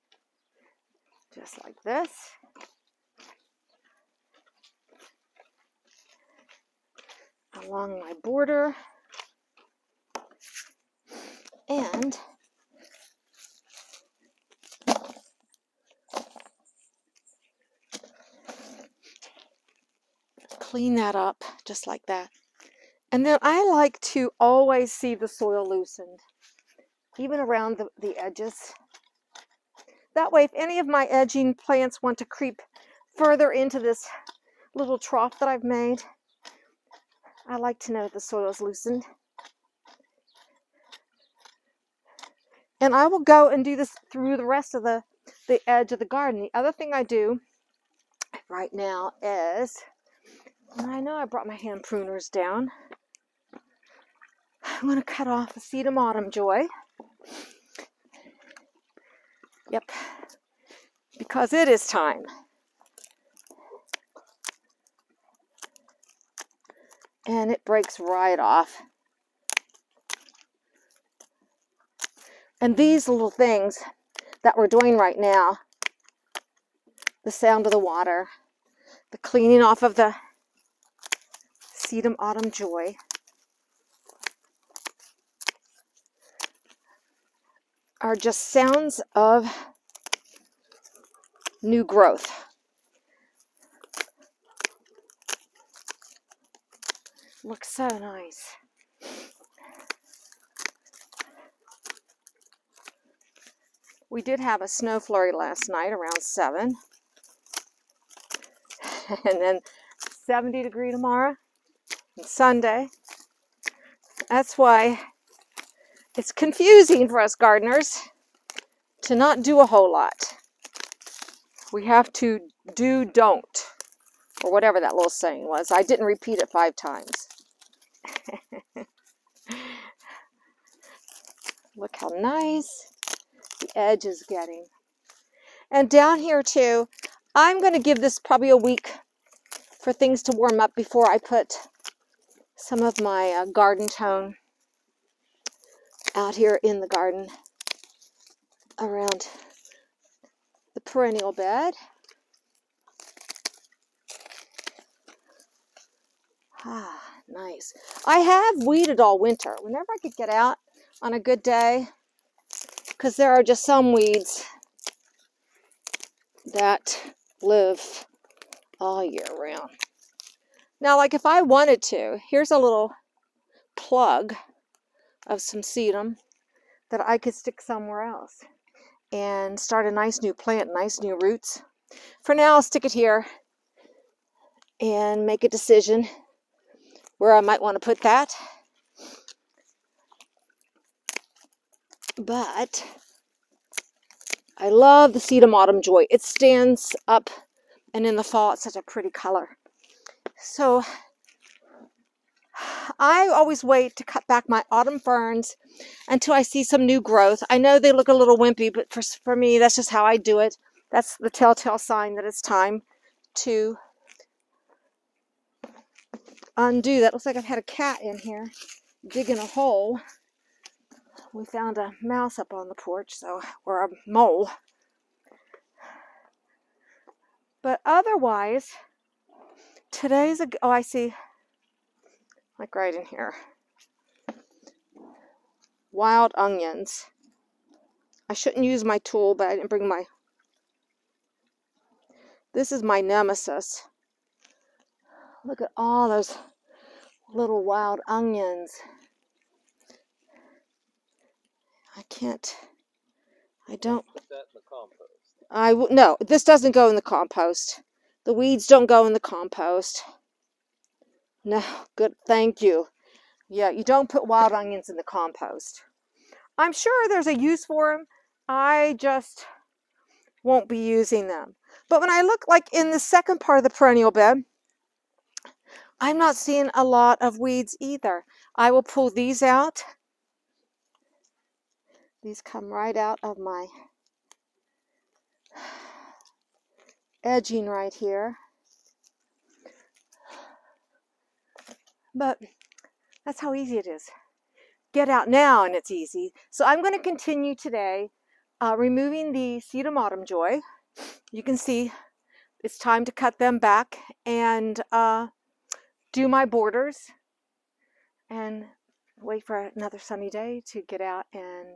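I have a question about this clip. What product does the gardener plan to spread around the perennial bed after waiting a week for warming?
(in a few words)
Garden tone.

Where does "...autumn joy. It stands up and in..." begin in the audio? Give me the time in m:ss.
3:15.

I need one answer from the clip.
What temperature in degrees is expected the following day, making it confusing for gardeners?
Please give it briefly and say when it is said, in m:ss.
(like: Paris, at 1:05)
70, at 1:50.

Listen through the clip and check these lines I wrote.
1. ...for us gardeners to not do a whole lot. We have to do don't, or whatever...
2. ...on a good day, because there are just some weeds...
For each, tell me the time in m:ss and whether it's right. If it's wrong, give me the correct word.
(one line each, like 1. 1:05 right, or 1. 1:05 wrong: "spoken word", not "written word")
1. 1:57 right
2. 2:41 right.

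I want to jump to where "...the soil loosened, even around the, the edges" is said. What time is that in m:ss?
0:25.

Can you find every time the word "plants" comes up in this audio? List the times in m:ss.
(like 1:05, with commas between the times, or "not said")
0:31, 3:00.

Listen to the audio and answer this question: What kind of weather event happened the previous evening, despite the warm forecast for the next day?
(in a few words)
A snow flurry.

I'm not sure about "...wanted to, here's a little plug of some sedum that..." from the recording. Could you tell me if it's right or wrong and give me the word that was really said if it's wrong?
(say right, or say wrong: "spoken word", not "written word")
right.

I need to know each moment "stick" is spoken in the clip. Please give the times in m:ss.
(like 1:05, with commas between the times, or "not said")
2:57, 3:02.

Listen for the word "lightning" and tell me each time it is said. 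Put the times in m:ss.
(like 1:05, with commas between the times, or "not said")
not said.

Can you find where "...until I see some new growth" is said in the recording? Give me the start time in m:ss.
3:26.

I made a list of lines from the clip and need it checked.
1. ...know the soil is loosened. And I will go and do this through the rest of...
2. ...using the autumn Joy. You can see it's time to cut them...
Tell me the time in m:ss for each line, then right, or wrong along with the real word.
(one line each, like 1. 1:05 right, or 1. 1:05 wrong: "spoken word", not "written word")
1. 0:37 right
2. 4:58 wrong: "removing", not "using".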